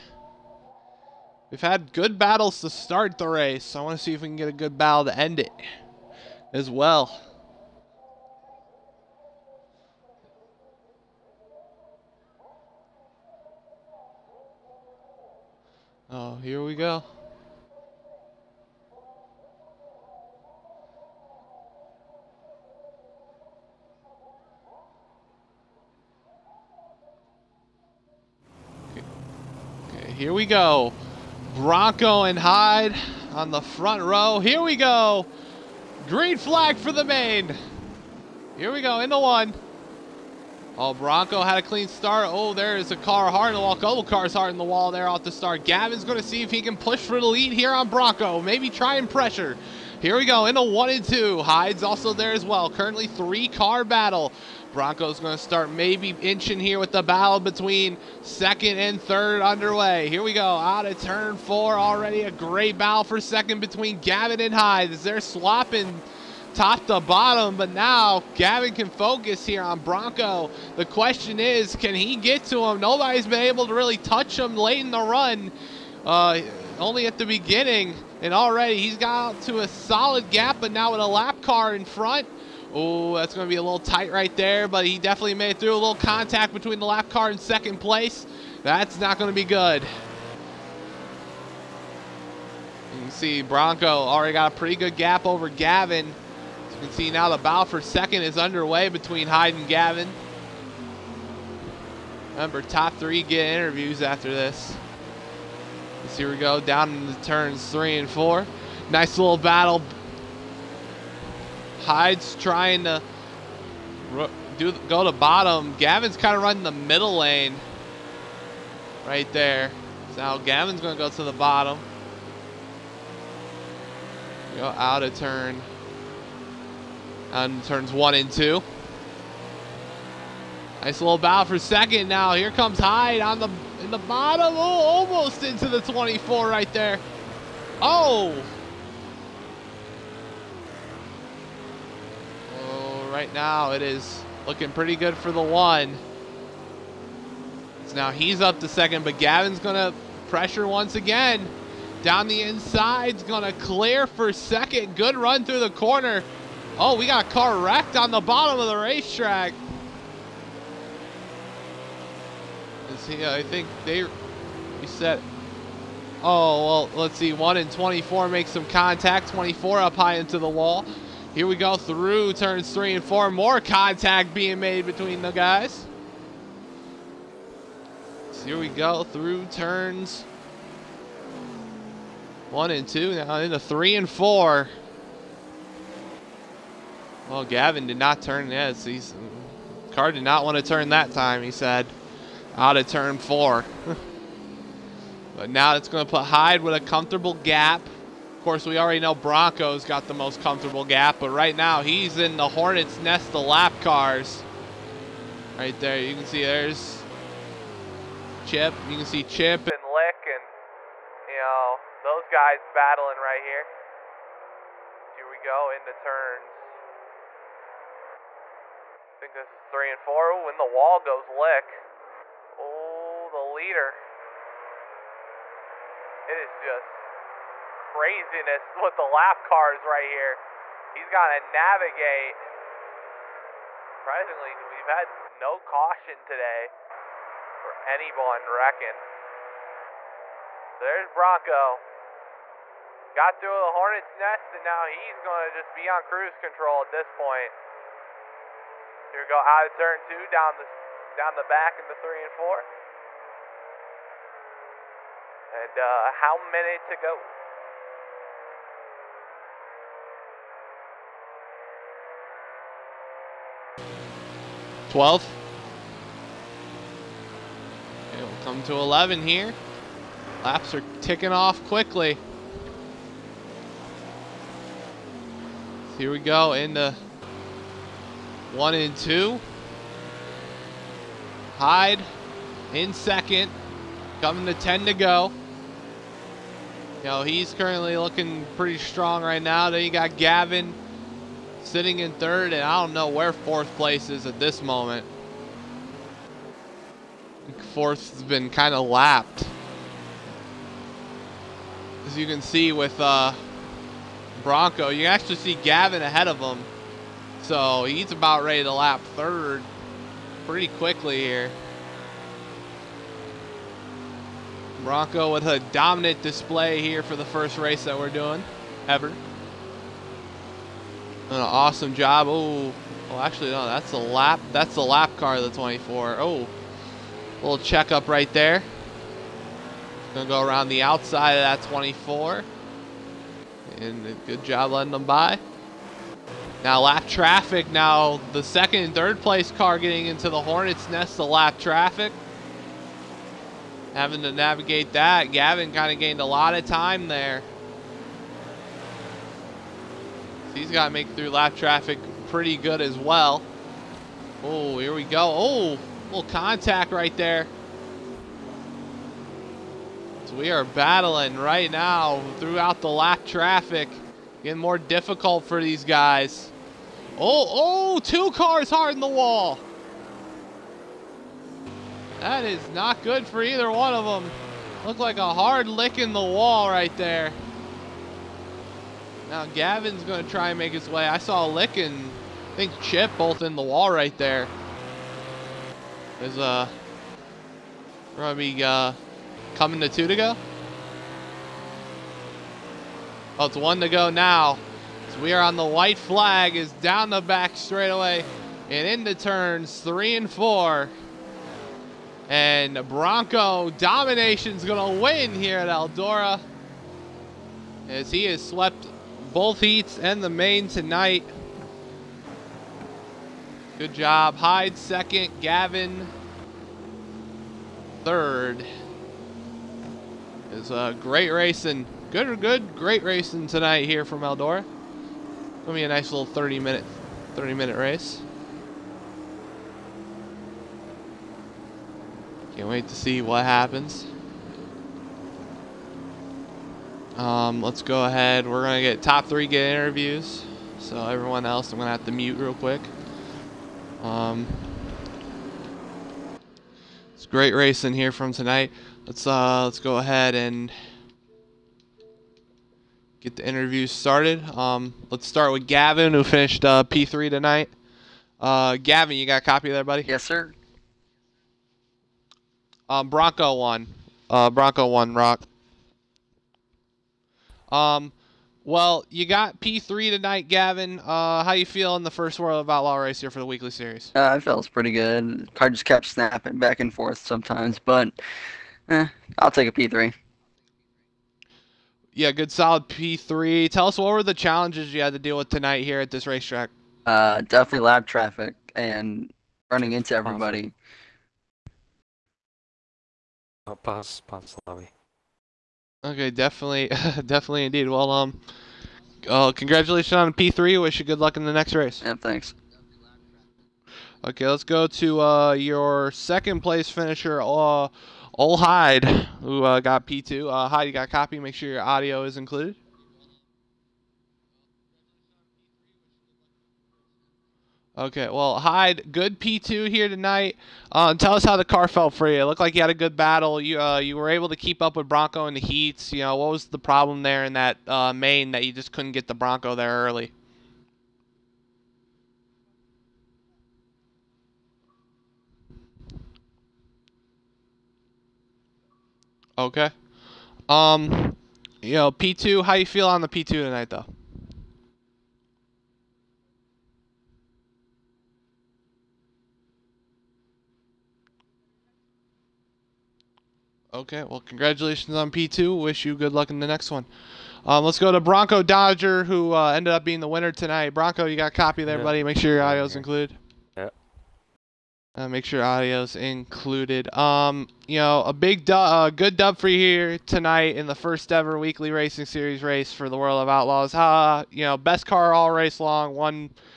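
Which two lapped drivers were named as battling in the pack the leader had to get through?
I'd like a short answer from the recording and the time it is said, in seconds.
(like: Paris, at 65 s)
Chip and Lick, at 209 s.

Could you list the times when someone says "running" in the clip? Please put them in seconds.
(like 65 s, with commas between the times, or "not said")
116 s, 489 s.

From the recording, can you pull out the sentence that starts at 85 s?
A little contact between the lap car and second place.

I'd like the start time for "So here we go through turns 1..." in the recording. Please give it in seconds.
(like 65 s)
178 s.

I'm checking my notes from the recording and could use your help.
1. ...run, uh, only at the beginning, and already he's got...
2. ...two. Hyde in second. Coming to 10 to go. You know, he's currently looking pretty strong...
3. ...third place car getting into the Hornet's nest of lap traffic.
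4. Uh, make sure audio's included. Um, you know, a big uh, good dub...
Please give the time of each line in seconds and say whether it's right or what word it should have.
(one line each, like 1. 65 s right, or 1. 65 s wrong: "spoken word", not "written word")
1. 75 s right
2. 278 s right
3. 338 s right
4. 565 s right.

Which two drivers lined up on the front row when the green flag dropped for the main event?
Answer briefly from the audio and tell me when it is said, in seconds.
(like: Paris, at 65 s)
Bronco and Hyde, at 31 s.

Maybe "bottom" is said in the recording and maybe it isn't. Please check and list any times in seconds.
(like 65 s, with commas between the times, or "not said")
67 s, 115 s, 121 s, 133 s, 158 s.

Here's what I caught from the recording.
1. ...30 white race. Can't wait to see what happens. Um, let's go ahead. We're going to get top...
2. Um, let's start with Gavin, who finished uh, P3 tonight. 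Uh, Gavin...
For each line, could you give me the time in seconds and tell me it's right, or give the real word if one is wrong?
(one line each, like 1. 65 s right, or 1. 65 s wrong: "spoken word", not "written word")
1. 427 s wrong: "minute", not "white"
2. 454 s right.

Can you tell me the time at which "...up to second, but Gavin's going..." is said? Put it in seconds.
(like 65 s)
148 s.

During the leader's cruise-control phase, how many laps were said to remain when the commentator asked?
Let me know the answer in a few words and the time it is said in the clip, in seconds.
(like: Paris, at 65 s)
12, at 264 s.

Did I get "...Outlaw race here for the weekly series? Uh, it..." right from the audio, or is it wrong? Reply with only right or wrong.
right.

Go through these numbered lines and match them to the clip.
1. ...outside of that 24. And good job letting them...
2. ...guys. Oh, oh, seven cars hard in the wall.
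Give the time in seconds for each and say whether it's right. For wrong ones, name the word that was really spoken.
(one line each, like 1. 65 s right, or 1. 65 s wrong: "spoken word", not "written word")
1. 330 s right
2. 365 s wrong: "two", not "seven".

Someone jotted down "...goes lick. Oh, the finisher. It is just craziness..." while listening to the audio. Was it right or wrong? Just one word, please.
wrong.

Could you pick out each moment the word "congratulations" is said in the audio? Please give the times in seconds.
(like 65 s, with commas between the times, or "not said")
499 s, 554 s.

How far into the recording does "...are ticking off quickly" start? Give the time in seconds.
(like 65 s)
270 s.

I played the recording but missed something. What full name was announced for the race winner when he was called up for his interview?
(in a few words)
Bronco Dodger.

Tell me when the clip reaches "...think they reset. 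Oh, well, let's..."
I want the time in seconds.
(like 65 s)
163 s.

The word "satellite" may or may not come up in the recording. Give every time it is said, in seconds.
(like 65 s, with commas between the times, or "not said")
not said.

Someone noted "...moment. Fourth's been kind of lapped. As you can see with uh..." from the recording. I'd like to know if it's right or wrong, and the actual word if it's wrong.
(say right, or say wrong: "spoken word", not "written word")
right.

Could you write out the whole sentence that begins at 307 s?
So he's about ready to lap third pretty quickly here.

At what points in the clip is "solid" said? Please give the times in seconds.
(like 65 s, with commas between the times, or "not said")
79 s, 482 s.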